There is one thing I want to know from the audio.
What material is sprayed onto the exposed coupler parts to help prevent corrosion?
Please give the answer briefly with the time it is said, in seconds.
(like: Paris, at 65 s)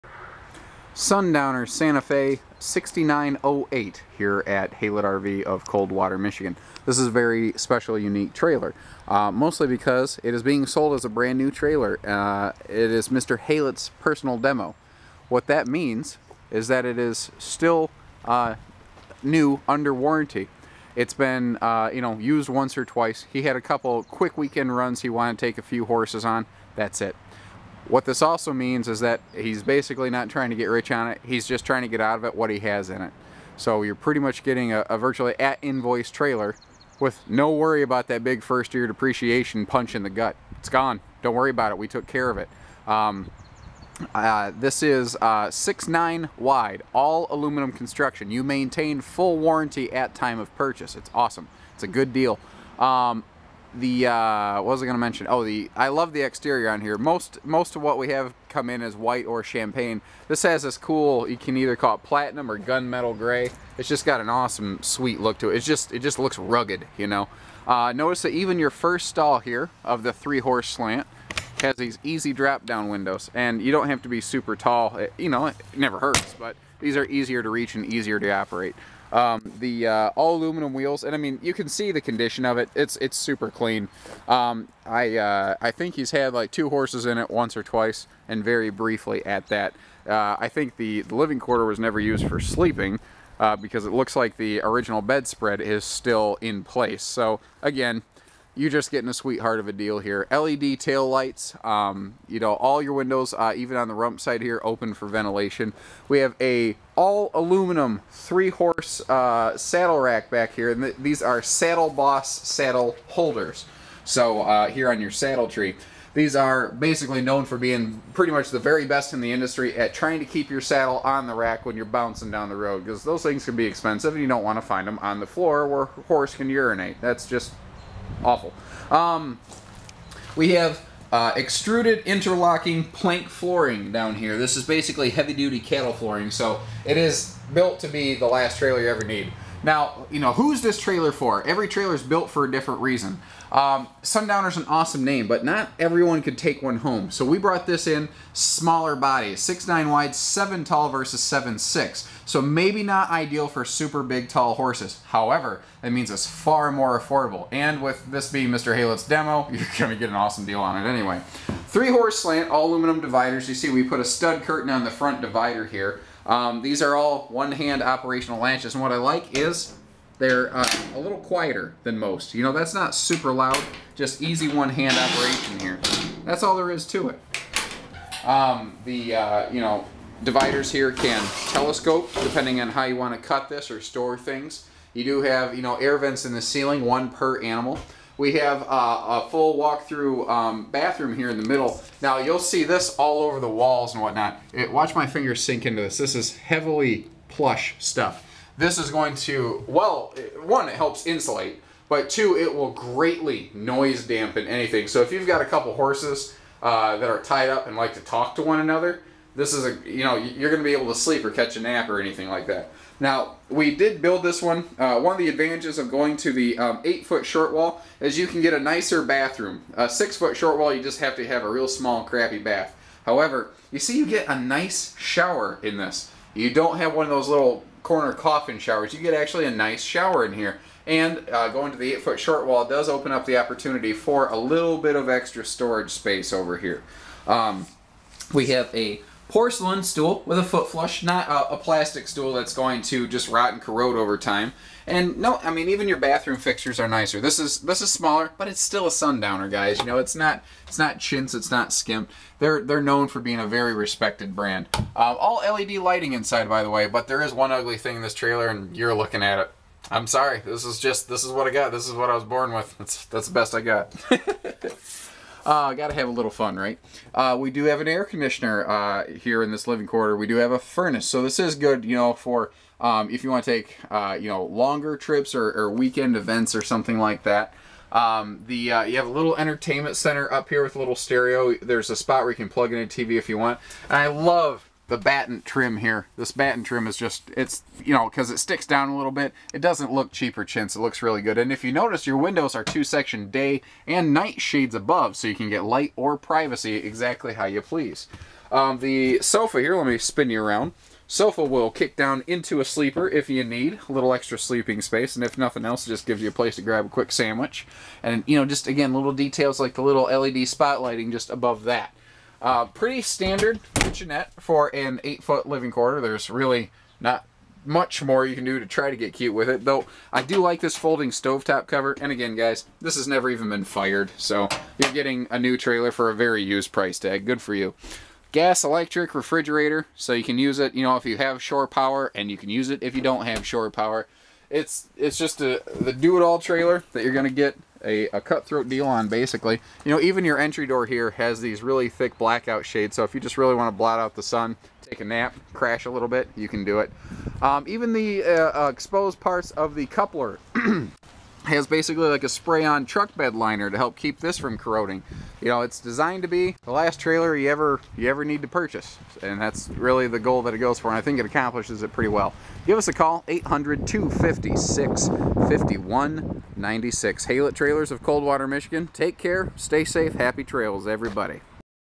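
Truck bed liner, at 352 s.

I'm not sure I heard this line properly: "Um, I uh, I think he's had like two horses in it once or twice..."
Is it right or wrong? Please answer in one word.
right.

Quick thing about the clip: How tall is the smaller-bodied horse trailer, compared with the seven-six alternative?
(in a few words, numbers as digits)
7 feet.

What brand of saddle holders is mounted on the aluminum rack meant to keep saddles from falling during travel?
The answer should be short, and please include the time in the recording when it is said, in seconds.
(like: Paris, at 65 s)
Saddle Boss, at 111 s.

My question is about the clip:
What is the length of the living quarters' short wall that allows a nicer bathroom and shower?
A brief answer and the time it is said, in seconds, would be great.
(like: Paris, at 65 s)
8 feet, at 216 s.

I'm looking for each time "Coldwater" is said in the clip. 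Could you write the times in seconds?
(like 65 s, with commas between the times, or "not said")
5 s, 368 s.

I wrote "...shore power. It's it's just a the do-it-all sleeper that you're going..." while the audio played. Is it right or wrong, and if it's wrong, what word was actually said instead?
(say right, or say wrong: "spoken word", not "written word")
wrong: "trailer", not "sleeper".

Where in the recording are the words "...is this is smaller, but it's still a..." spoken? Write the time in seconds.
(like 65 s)
247 s.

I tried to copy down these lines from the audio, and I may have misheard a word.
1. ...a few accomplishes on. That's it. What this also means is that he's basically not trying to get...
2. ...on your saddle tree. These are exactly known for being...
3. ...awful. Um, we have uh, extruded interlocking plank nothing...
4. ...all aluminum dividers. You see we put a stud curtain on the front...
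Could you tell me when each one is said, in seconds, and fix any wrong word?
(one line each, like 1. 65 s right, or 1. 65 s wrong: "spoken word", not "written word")
1. 25 s wrong: "horses", not "accomplishes"
2. 114 s wrong: "basically", not "exactly"
3. 128 s wrong: "flooring", not "nothing"
4. 162 s right.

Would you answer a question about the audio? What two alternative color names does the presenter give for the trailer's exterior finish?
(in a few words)
Platinum or gunmetal gray.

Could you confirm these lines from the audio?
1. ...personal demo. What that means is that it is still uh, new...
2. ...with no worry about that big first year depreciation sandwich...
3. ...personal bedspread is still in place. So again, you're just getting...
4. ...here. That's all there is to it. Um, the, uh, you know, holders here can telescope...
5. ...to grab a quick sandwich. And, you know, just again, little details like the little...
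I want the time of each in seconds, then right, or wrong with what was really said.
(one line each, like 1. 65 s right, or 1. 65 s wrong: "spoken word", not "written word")
1. 14 s right
2. 36 s wrong: "punch", not "sandwich"
3. 94 s wrong: "original", not "personal"
4. 175 s wrong: "dividers", not "holders"
5. 306 s right.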